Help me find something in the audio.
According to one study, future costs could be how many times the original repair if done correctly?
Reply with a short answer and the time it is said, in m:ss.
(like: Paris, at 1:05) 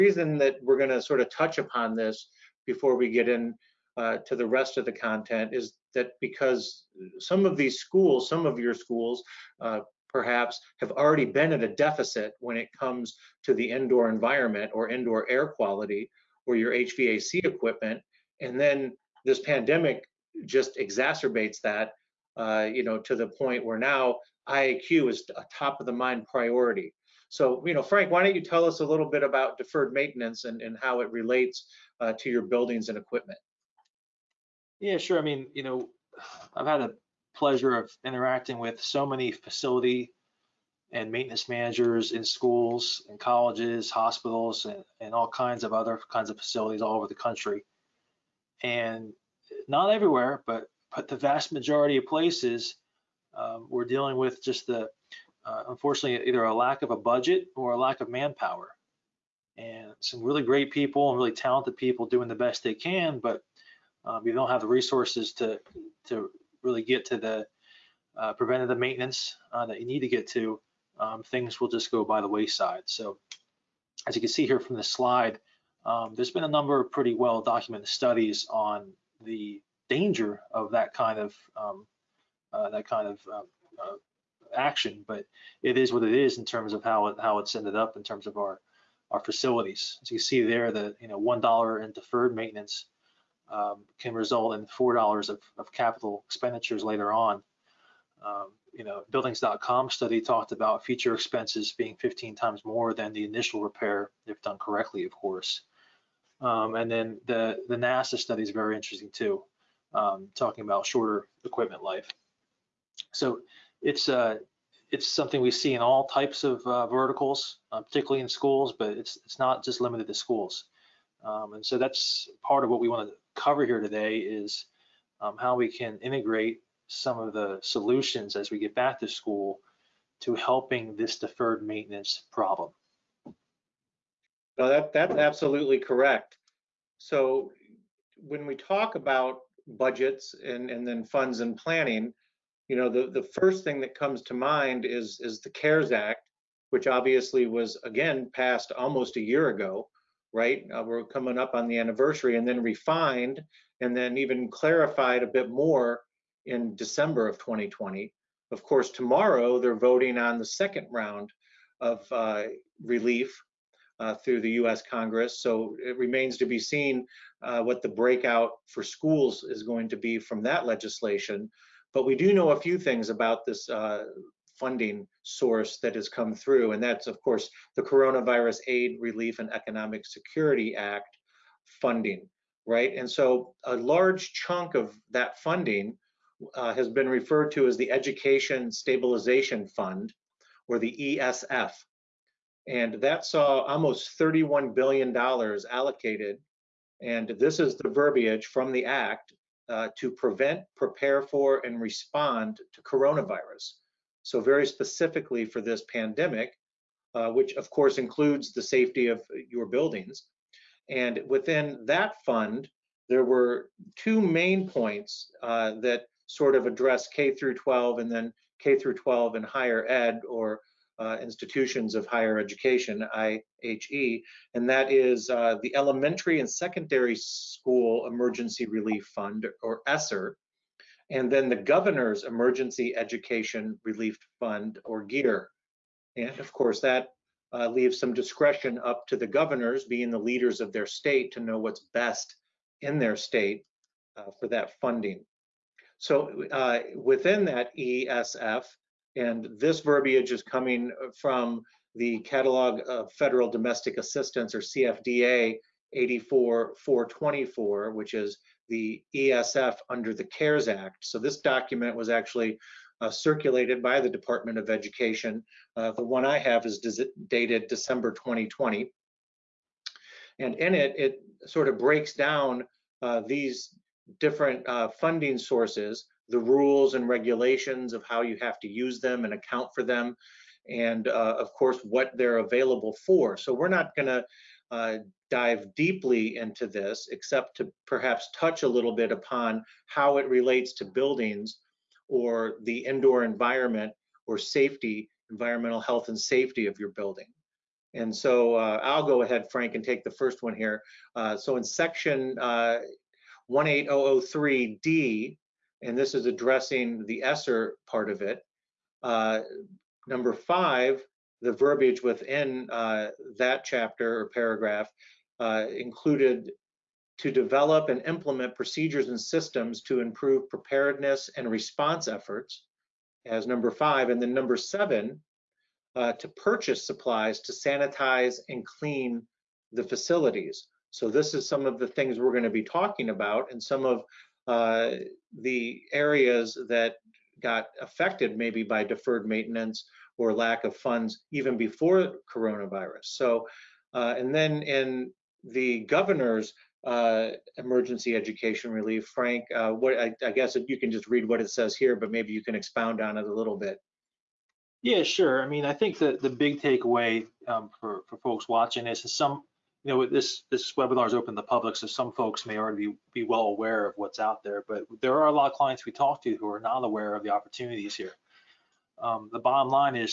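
15, at 1:41.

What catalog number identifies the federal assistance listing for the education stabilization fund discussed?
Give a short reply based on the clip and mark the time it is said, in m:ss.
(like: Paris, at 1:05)
84424, at 4:15.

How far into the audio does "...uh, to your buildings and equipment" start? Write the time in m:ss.
0:31.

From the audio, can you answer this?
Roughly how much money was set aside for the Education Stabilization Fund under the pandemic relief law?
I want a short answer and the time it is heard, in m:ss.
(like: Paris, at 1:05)
$31 billion, at 3:14.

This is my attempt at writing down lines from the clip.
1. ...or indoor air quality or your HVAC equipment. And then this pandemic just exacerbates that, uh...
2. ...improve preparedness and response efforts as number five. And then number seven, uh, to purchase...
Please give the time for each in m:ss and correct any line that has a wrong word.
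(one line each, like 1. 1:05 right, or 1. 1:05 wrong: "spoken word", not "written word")
1. 0:14 right
2. 5:19 right.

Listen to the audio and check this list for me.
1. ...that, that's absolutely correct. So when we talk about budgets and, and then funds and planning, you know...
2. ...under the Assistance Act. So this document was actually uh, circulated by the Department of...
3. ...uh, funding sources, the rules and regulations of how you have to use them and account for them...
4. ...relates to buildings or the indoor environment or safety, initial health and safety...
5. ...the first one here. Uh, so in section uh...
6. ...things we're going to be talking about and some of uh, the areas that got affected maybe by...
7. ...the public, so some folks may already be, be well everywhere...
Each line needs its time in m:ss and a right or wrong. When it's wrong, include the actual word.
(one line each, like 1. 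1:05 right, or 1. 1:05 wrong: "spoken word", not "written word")
1. 2:14 right
2. 4:19 wrong: "CARES", not "Assistance"
3. 4:34 right
4. 4:50 wrong: "environmental", not "initial"
5. 5:00 right
6. 5:31 right
7. 6:01 wrong: "aware", not "everywhere".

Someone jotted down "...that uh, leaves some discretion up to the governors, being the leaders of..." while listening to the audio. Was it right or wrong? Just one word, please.
right.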